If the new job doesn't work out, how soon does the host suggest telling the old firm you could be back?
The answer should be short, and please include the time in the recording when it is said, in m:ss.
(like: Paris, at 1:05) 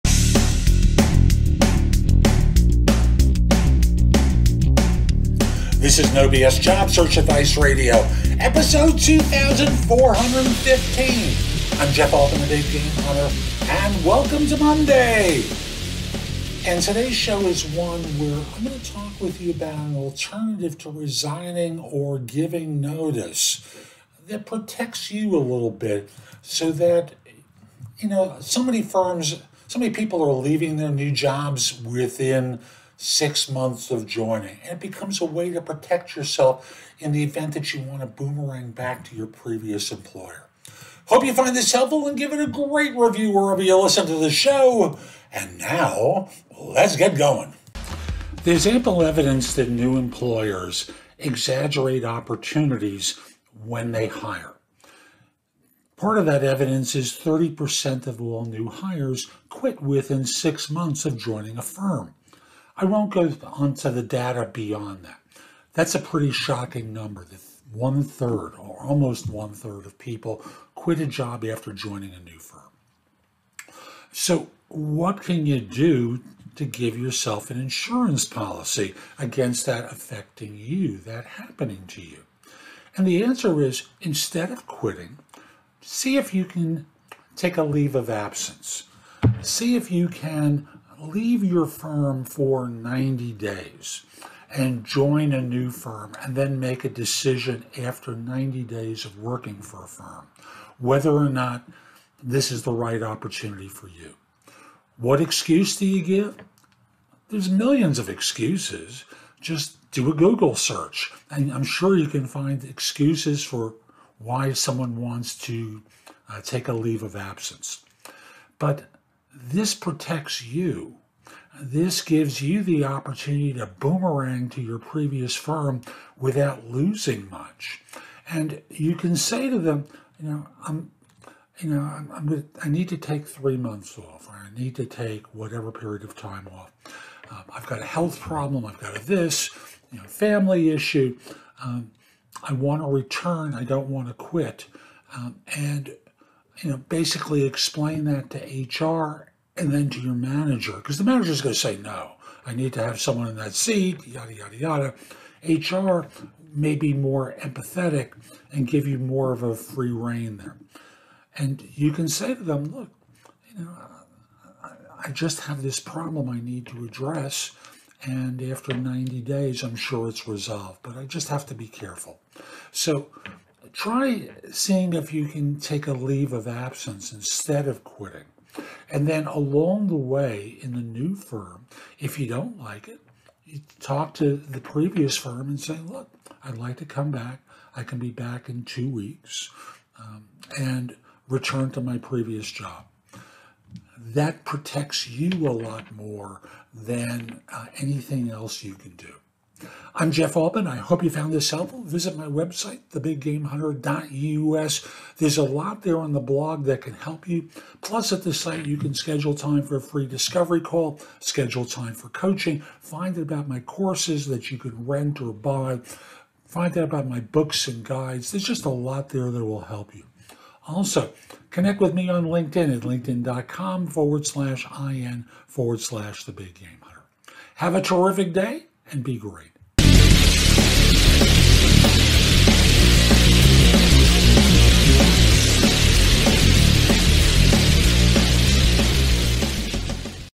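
two weeks, at 3:08.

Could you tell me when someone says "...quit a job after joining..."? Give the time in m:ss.
1:10.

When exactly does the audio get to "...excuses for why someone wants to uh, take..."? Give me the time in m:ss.
1:52.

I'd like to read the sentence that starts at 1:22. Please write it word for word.
And the answer is instead of quitting, see if you can take a leave of absence.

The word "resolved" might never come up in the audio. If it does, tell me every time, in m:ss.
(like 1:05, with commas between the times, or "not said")
2:50.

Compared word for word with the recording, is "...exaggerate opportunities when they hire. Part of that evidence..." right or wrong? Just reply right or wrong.
right.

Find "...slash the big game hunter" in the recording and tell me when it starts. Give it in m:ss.
3:45.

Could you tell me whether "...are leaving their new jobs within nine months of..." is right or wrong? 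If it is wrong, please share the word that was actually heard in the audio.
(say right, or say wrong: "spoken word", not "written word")
wrong: "six", not "nine".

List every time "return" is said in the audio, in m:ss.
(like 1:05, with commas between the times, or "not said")
2:22, 3:11.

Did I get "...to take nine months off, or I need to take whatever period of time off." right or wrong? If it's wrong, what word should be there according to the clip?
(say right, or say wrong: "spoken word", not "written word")
wrong: "three", not "nine".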